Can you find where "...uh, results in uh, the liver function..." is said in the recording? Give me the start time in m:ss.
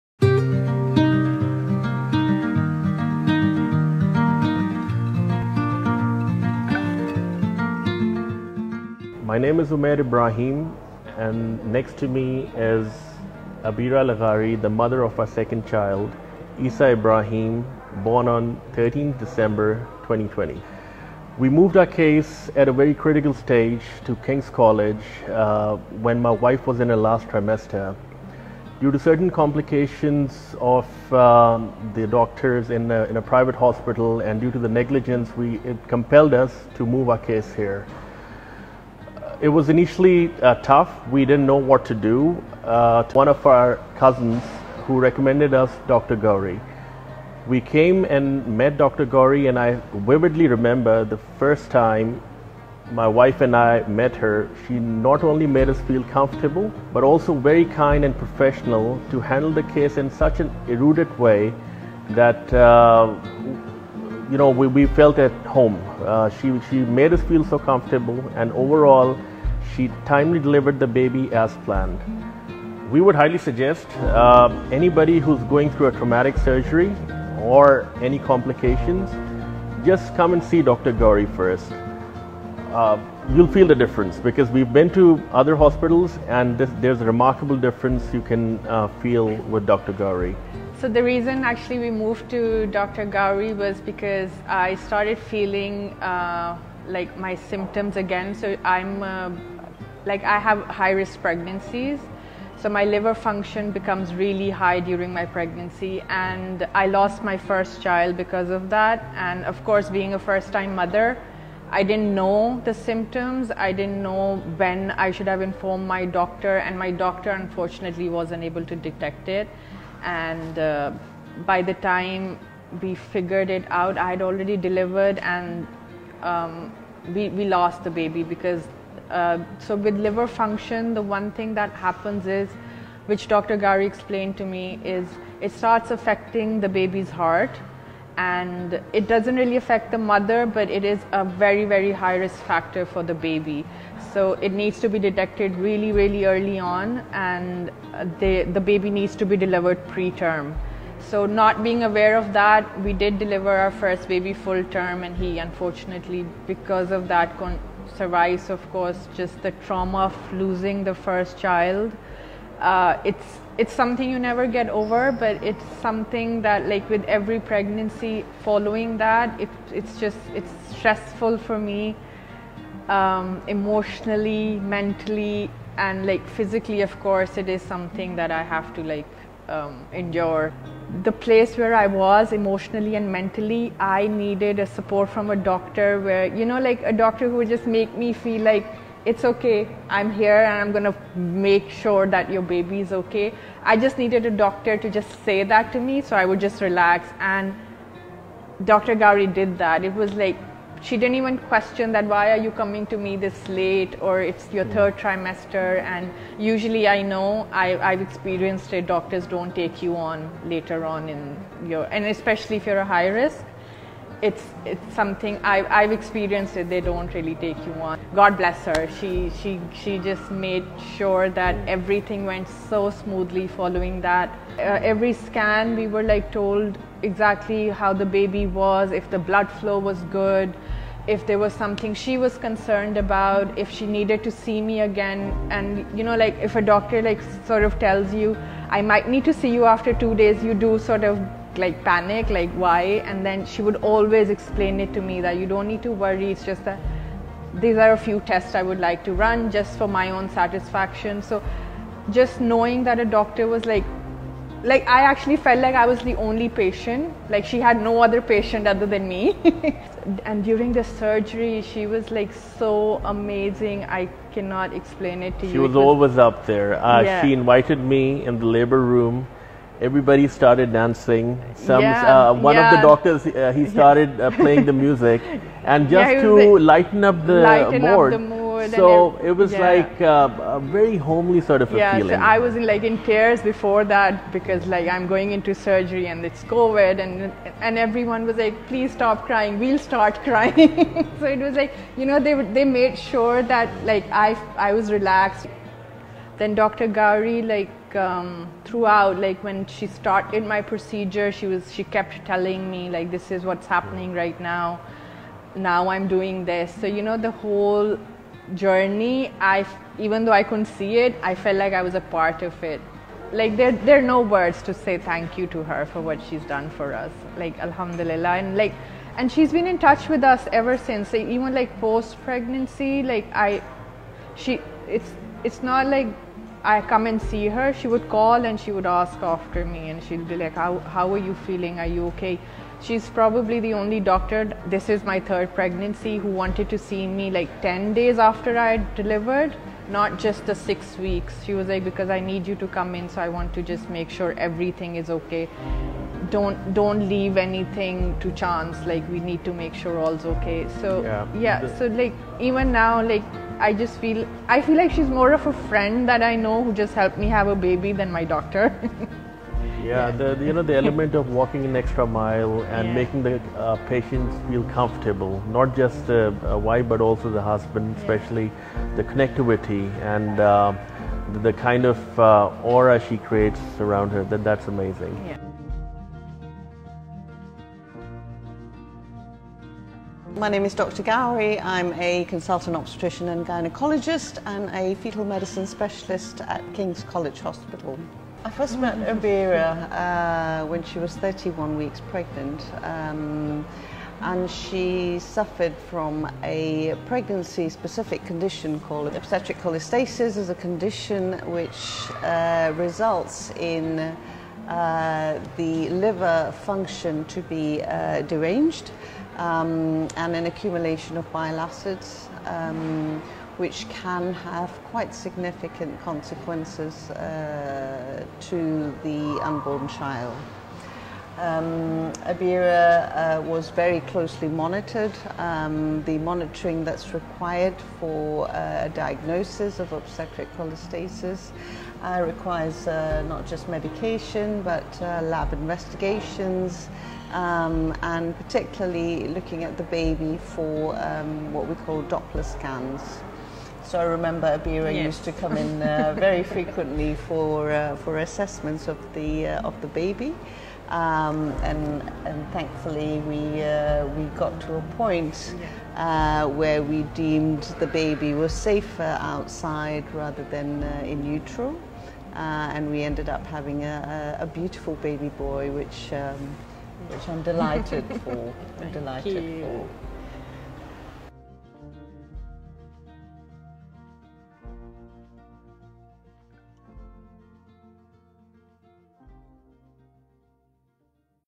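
6:42.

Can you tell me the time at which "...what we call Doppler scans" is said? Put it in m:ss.
7:21.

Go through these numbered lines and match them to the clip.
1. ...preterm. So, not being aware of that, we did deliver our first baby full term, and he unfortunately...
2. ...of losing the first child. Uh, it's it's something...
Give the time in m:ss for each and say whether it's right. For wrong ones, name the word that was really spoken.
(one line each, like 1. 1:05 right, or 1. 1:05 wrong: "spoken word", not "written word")
1. 2:29 right
2. 2:40 right.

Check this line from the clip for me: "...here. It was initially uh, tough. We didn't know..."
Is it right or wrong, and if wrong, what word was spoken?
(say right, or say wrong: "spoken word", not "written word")
right.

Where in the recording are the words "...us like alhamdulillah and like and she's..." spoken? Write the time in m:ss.
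5:16.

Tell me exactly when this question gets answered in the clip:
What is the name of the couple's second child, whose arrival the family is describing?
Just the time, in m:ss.
0:16.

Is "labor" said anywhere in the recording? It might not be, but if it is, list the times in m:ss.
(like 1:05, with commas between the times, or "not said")
4:28.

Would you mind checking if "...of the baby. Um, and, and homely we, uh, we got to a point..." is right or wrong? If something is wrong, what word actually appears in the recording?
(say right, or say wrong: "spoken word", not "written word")
wrong: "thankfully", not "homely".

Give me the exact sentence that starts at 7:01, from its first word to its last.
Um, Abeera uh, was very closely monitored.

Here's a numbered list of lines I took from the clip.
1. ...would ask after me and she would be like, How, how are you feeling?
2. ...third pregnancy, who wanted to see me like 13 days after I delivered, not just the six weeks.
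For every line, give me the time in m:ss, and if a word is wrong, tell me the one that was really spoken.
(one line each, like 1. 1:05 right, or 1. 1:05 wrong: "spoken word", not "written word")
1. 5:28 right
2. 5:35 wrong: "10", not "13".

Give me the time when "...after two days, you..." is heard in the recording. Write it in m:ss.
3:59.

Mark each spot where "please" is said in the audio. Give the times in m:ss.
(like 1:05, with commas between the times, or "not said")
4:48.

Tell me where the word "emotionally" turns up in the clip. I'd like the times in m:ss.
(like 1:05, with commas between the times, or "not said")
2:53, 3:02.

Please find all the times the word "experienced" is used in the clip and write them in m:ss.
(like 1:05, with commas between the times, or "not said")
3:28, 3:35.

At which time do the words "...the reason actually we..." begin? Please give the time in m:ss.
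1:30.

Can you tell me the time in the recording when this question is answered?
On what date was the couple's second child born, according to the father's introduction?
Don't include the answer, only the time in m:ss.
0:18.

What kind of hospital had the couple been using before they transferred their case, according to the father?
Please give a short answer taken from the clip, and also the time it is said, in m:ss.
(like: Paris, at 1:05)
Private hospital, at 0:33.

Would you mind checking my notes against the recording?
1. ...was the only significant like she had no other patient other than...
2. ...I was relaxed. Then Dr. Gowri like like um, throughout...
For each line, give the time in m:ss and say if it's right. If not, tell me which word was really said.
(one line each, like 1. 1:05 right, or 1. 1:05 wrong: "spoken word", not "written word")
1. 4:15 wrong: "patient", not "significant"
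2. 4:54 right.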